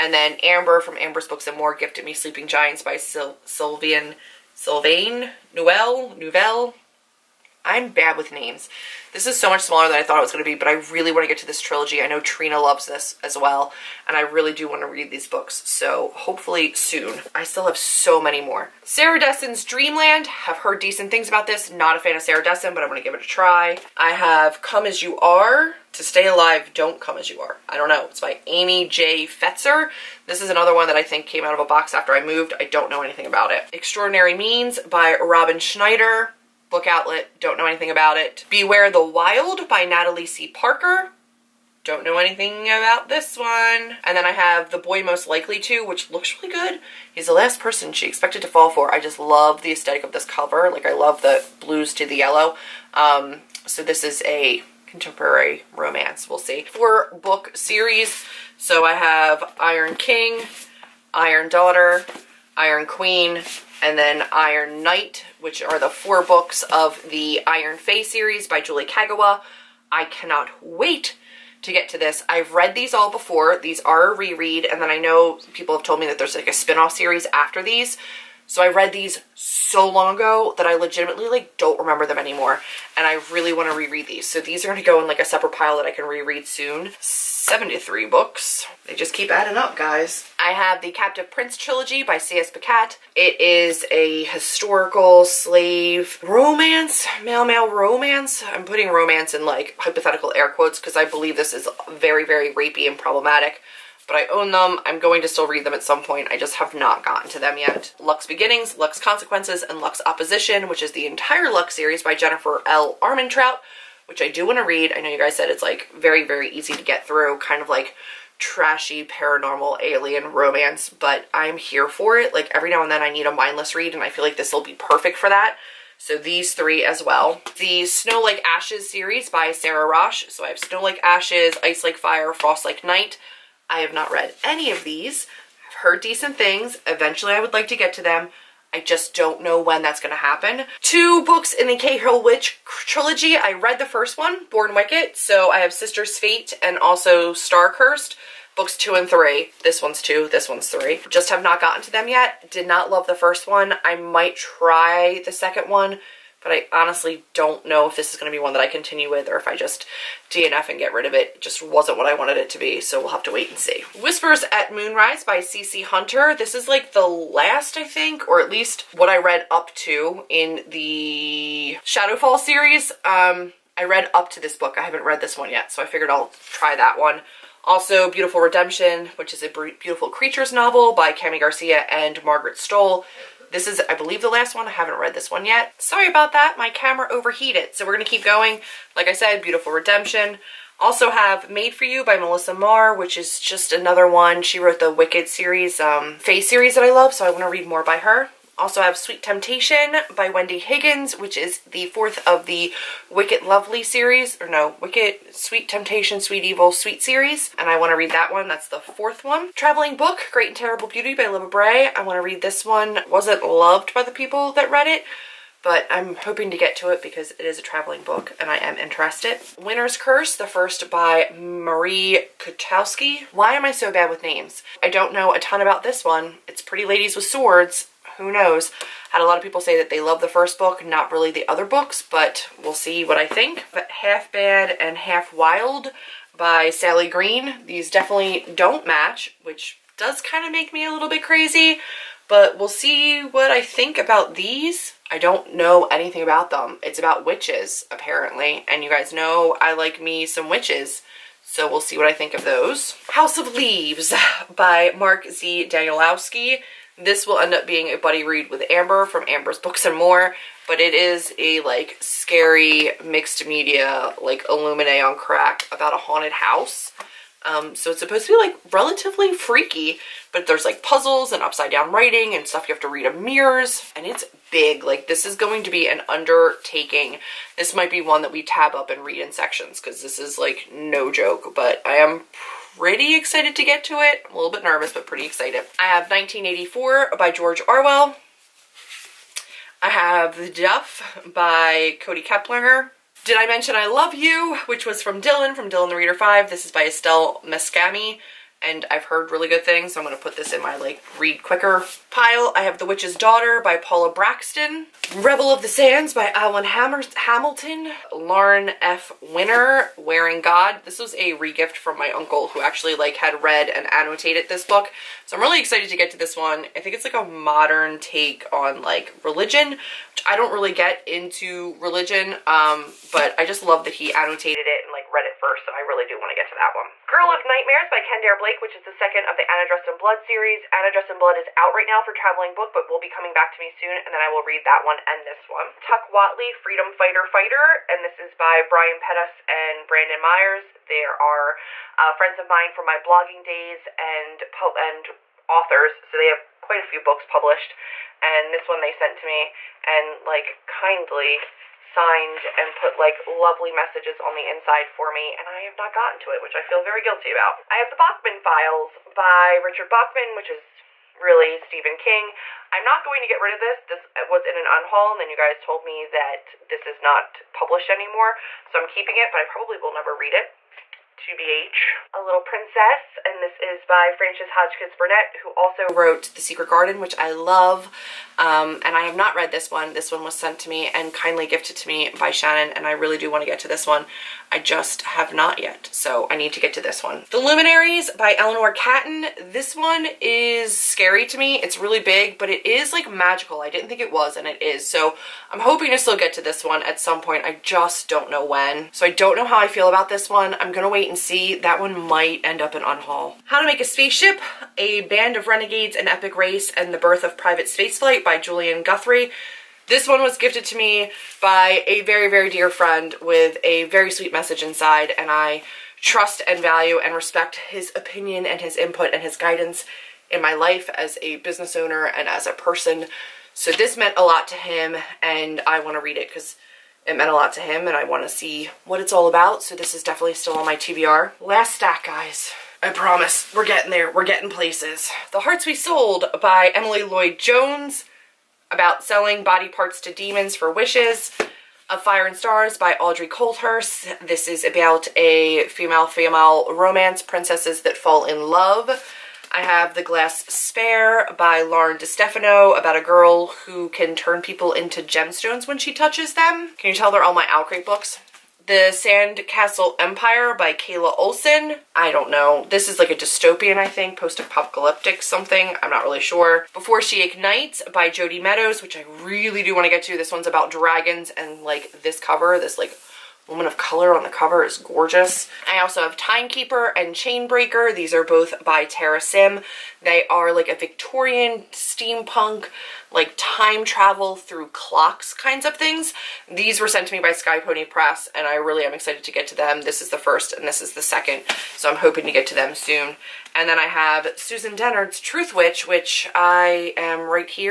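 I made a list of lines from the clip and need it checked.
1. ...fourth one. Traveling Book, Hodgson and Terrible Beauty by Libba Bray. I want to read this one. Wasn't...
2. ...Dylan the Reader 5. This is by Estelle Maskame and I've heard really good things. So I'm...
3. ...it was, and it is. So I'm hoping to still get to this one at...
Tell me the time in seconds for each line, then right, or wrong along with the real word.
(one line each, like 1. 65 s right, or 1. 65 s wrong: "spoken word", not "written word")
1. 208 s wrong: "Great", not "Hodgson"
2. 295 s right
3. 394 s right.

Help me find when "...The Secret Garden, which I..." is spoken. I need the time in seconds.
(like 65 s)
376 s.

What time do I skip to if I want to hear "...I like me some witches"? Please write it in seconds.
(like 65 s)
249 s.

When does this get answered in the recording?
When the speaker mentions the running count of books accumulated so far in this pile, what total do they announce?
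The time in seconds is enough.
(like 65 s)
87 s.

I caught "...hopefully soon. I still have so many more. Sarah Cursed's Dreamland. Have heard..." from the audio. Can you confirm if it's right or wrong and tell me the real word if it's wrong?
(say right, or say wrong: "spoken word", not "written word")
wrong: "Dessen", not "Cursed".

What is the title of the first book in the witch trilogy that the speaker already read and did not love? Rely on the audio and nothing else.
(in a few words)
Born Wicked.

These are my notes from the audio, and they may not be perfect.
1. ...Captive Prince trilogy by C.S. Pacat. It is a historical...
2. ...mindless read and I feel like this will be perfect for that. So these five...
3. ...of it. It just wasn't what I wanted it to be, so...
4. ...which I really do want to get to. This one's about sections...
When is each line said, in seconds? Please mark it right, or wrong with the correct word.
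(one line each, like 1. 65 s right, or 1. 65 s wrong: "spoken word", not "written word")
1. 90 s right
2. 123 s wrong: "three", not "five"
3. 161 s right
4. 468 s wrong: "dragons", not "sections".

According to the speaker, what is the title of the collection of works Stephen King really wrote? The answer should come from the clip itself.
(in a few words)
the Bachman Files.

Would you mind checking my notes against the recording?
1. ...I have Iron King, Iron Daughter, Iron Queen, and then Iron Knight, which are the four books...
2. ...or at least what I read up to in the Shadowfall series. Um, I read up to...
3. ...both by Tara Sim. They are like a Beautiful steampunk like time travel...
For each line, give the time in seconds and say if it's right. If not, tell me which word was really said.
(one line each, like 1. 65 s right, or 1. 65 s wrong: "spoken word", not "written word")
1. 58 s right
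2. 168 s right
3. 478 s wrong: "Victorian", not "Beautiful".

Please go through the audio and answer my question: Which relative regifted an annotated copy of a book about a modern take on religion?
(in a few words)
uncle.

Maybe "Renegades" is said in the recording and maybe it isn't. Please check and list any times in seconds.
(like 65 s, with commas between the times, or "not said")
405 s.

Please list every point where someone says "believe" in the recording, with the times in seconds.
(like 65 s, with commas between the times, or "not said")
101 s, 183 s.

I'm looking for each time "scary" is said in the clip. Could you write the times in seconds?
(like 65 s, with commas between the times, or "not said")
262 s, 390 s.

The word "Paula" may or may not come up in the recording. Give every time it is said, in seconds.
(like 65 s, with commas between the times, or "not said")
303 s.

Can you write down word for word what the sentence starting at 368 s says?
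So I'm keeping it, but I probably will never read it.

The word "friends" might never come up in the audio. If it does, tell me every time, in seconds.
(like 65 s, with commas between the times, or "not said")
342 s, 412 s.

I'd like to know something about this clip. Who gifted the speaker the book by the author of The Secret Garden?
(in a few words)
Shannon.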